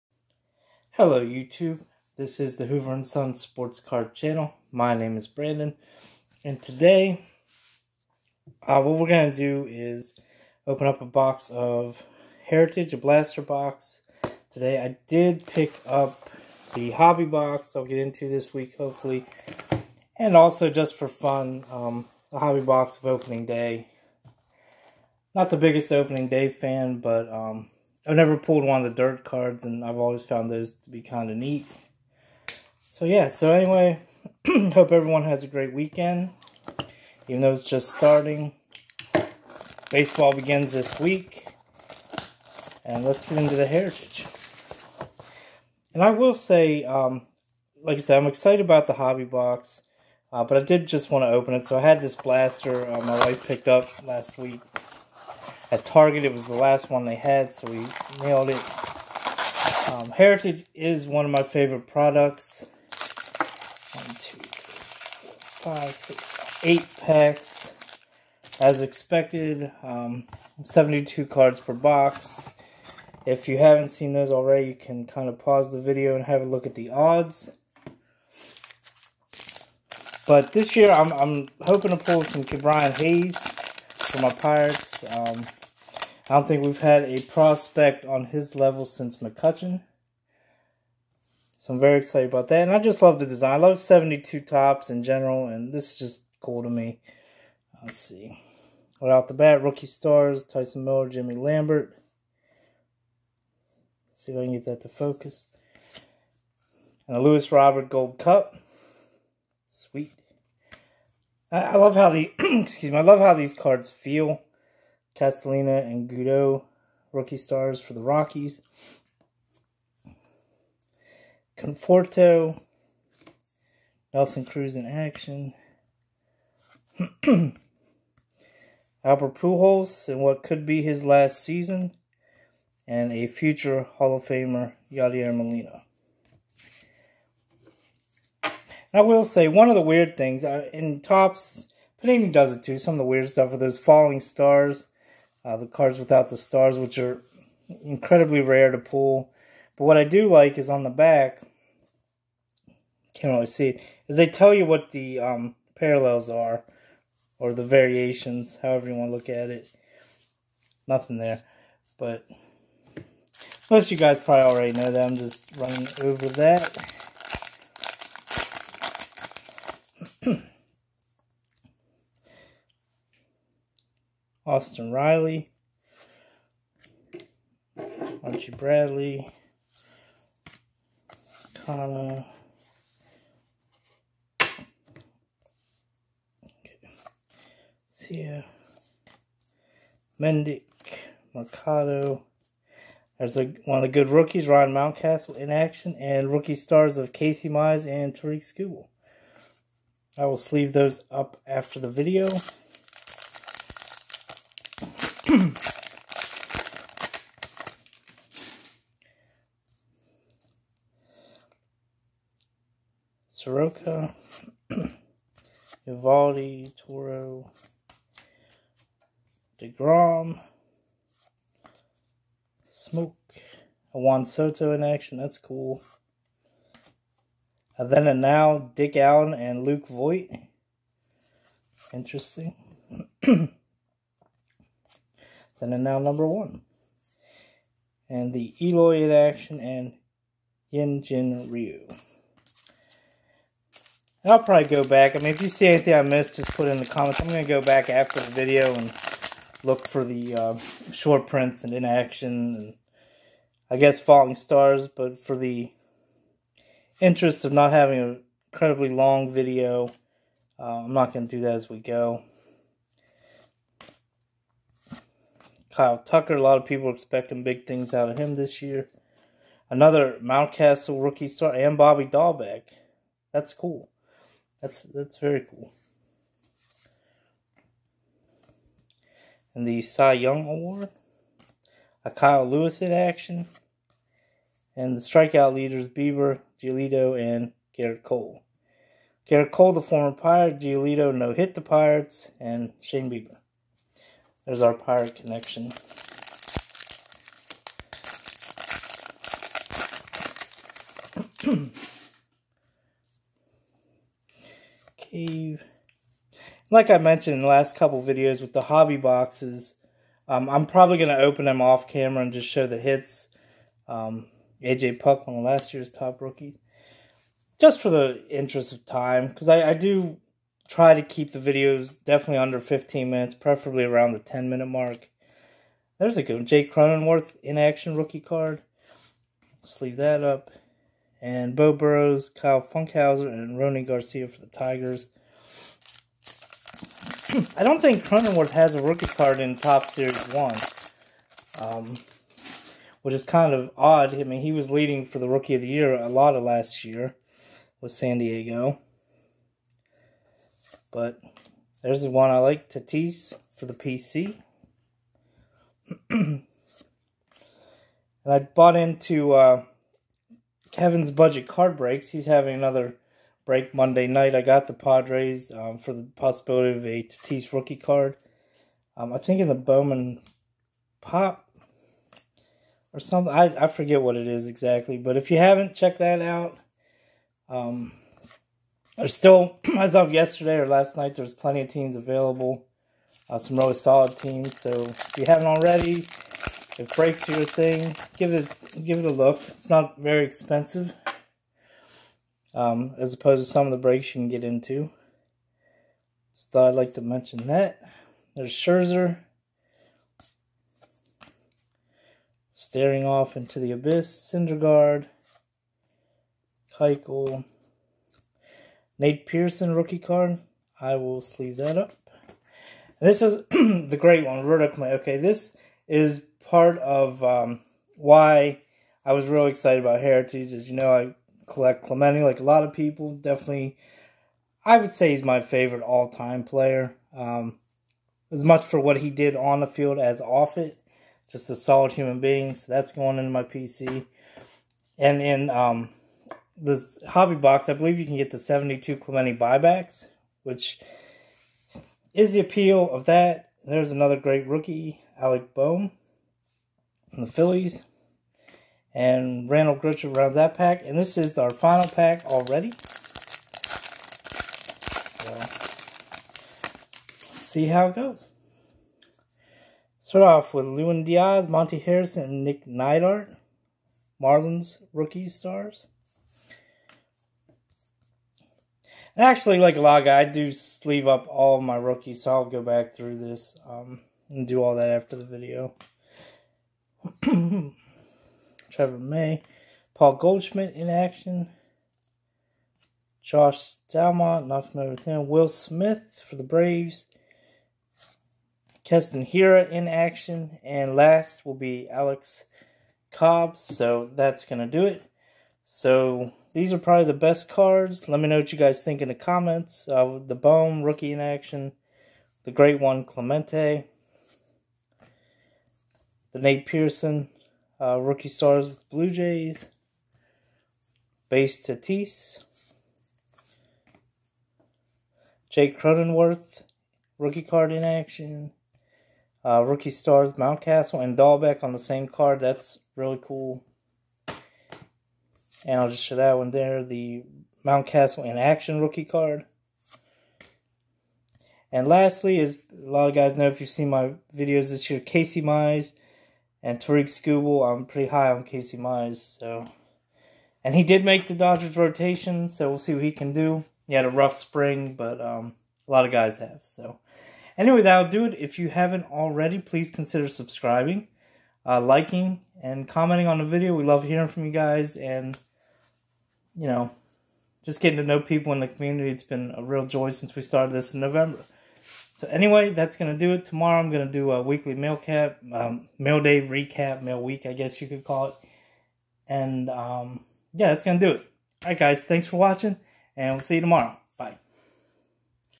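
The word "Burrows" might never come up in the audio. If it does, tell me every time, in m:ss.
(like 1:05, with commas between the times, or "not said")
5:31.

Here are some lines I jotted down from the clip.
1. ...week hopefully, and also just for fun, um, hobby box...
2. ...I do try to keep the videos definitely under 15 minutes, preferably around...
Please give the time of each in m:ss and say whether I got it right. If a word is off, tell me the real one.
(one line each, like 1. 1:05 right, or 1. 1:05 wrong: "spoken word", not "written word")
1. 0:18 right
2. 5:19 right.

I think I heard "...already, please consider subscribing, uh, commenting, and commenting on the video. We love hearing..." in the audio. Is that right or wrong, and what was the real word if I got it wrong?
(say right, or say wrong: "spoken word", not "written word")
wrong: "liking", not "commenting".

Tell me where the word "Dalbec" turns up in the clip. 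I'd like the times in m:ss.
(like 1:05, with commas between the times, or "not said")
4:32, 8:41.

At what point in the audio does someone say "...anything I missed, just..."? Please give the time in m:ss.
4:05.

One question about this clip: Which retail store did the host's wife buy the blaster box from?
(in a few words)
Target.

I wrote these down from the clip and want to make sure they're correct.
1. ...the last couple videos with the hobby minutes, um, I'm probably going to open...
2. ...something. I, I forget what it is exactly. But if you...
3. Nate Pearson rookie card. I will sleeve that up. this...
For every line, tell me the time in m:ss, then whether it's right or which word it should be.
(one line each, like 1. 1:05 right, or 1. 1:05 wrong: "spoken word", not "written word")
1. 5:07 wrong: "boxes", not "minutes"
2. 6:12 right
3. 6:48 right.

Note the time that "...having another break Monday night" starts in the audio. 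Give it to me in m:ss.
6:02.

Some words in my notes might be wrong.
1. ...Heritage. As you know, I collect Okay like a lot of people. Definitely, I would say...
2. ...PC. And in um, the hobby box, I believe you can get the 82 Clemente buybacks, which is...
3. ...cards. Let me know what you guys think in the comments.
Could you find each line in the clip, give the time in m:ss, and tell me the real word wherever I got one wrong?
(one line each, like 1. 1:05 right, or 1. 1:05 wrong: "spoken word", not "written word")
1. 7:00 wrong: "Clemente", not "Okay"
2. 7:13 wrong: "72", not "82"
3. 8:17 right.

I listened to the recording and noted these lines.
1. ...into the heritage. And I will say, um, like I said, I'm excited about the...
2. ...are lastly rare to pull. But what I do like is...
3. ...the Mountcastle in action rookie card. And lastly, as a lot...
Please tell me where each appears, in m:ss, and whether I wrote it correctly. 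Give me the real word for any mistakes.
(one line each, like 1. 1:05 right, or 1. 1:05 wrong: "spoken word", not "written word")
1. 0:43 right
2. 2:26 wrong: "incredibly", not "lastly"
3. 8:46 right.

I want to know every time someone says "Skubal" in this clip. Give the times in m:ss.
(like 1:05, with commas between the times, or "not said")
3:18, 8:57.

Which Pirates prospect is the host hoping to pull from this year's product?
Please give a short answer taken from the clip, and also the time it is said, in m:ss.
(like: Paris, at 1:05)
Brian Hayes, at 1:22.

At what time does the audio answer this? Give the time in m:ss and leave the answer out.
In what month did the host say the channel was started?
9:21.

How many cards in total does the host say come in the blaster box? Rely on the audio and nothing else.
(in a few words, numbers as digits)
72.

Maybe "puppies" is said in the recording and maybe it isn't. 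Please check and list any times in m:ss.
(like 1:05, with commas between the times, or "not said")
not said.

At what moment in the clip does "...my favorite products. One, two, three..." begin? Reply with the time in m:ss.
1:01.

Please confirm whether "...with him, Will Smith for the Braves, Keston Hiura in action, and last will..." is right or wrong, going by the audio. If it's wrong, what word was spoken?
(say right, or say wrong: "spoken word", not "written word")
right.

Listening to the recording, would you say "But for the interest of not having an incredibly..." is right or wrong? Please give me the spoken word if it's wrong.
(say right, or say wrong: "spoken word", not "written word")
right.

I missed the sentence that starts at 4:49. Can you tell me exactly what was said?
Garrett Cole, the former Pirate, Giolito no hit the Pirates, and Shane Bieber.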